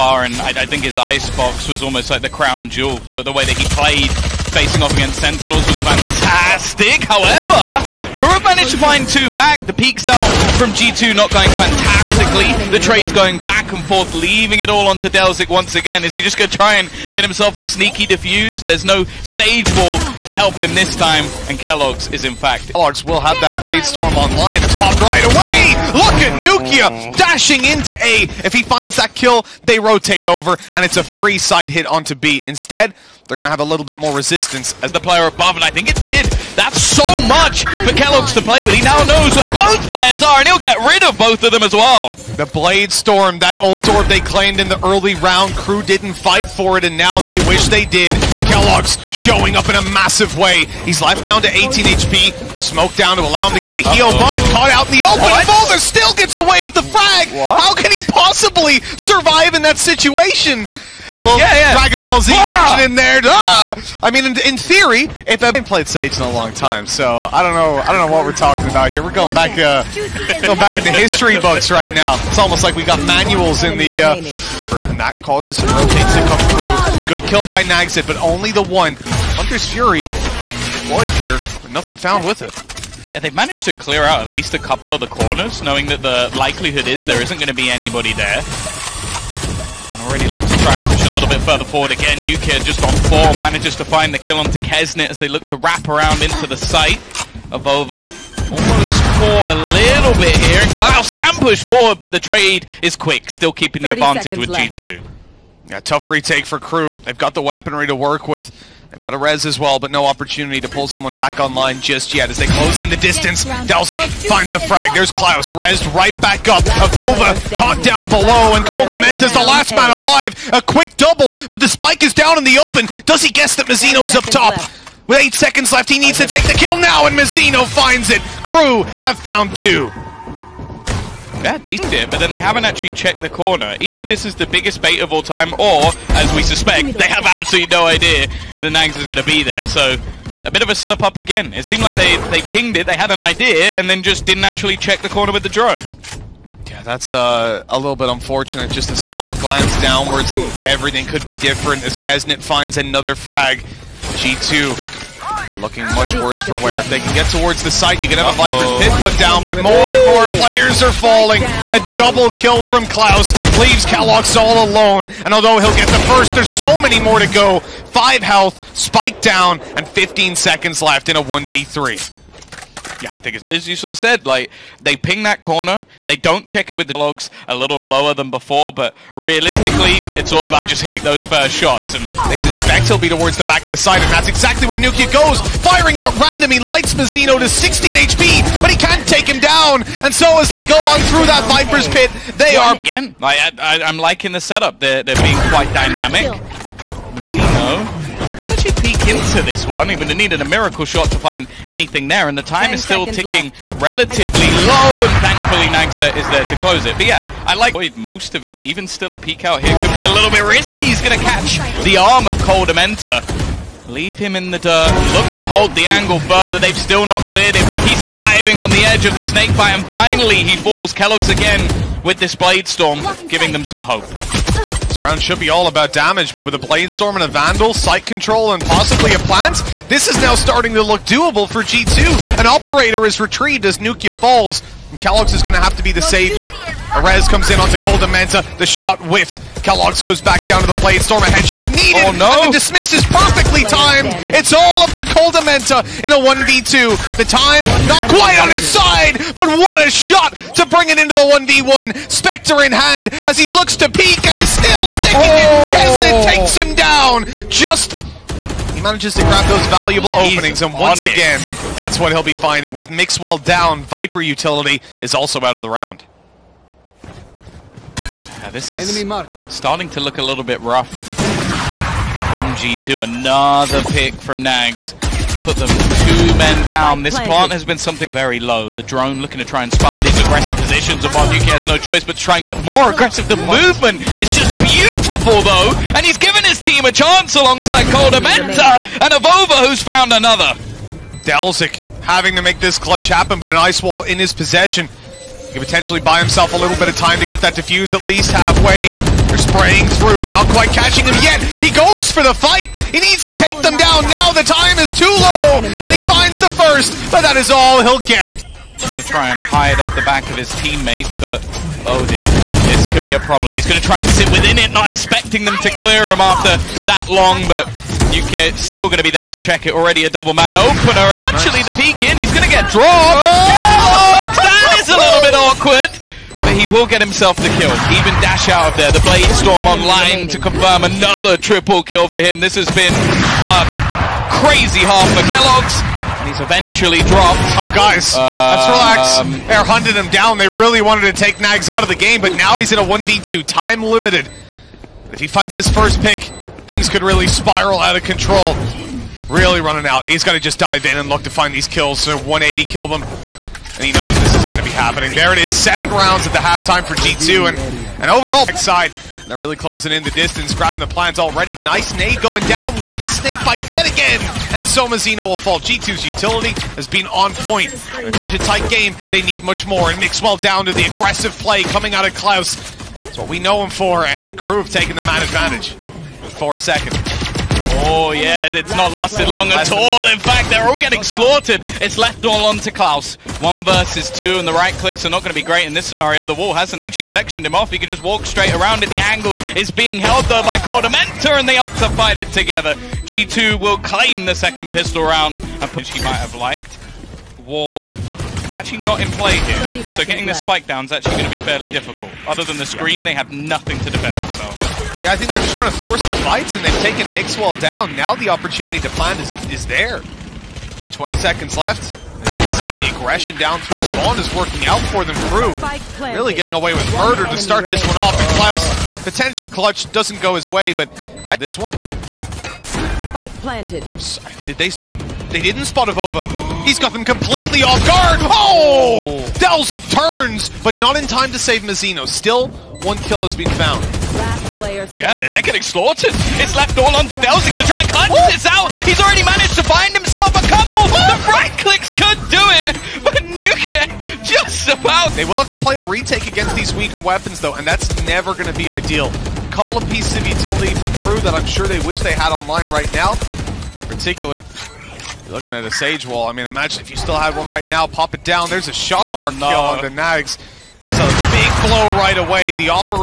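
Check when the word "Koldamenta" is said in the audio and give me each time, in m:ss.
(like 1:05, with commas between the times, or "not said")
3:32, 4:47, 6:30.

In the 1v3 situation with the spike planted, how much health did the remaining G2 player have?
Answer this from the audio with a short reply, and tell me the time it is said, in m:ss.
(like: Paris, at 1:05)
5, at 2:47.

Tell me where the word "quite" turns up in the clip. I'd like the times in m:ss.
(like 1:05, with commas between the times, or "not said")
3:15, 4:08, 5:00.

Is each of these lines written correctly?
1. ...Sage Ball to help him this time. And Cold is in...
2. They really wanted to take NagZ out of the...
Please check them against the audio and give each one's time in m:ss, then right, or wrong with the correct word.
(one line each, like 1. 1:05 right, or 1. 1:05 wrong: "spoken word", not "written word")
1. 0:19 wrong: "Keloqz", not "Cold"
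2. 5:40 right.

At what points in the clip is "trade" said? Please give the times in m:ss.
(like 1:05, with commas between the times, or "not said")
0:12, 1:42.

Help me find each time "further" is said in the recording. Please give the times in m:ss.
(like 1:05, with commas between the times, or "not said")
1:31, 3:36.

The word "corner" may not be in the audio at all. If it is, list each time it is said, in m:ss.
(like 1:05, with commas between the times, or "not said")
1:25, 2:13, 2:25, 2:55.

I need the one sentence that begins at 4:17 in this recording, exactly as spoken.
Just he manages to grab those valuable He's openings, and once again, that's what he'll be finding.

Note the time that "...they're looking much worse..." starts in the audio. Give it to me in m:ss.
2:35.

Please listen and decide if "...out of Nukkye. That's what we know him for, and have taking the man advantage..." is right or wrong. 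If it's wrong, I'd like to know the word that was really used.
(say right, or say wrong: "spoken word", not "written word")
wrong: "Klaus", not "Nukkye".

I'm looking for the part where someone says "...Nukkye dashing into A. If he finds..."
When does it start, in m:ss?
0:26.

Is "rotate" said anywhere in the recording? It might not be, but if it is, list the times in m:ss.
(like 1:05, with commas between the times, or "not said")
0:29, 1:15.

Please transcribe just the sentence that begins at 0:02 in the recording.
The, the way that he played facing off against Sentinels was fantastic.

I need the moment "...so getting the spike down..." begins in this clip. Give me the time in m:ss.
6:39.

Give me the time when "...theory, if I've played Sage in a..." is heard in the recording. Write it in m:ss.
1:04.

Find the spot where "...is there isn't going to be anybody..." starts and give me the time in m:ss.
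1:26.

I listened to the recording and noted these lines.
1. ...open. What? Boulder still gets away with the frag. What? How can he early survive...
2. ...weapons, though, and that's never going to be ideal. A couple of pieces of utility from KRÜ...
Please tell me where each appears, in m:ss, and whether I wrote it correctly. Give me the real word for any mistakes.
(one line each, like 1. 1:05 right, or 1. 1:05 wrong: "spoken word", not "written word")
1. 0:55 wrong: "possibly", not "early"
2. 7:26 right.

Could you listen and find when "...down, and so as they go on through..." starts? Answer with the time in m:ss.
3:09.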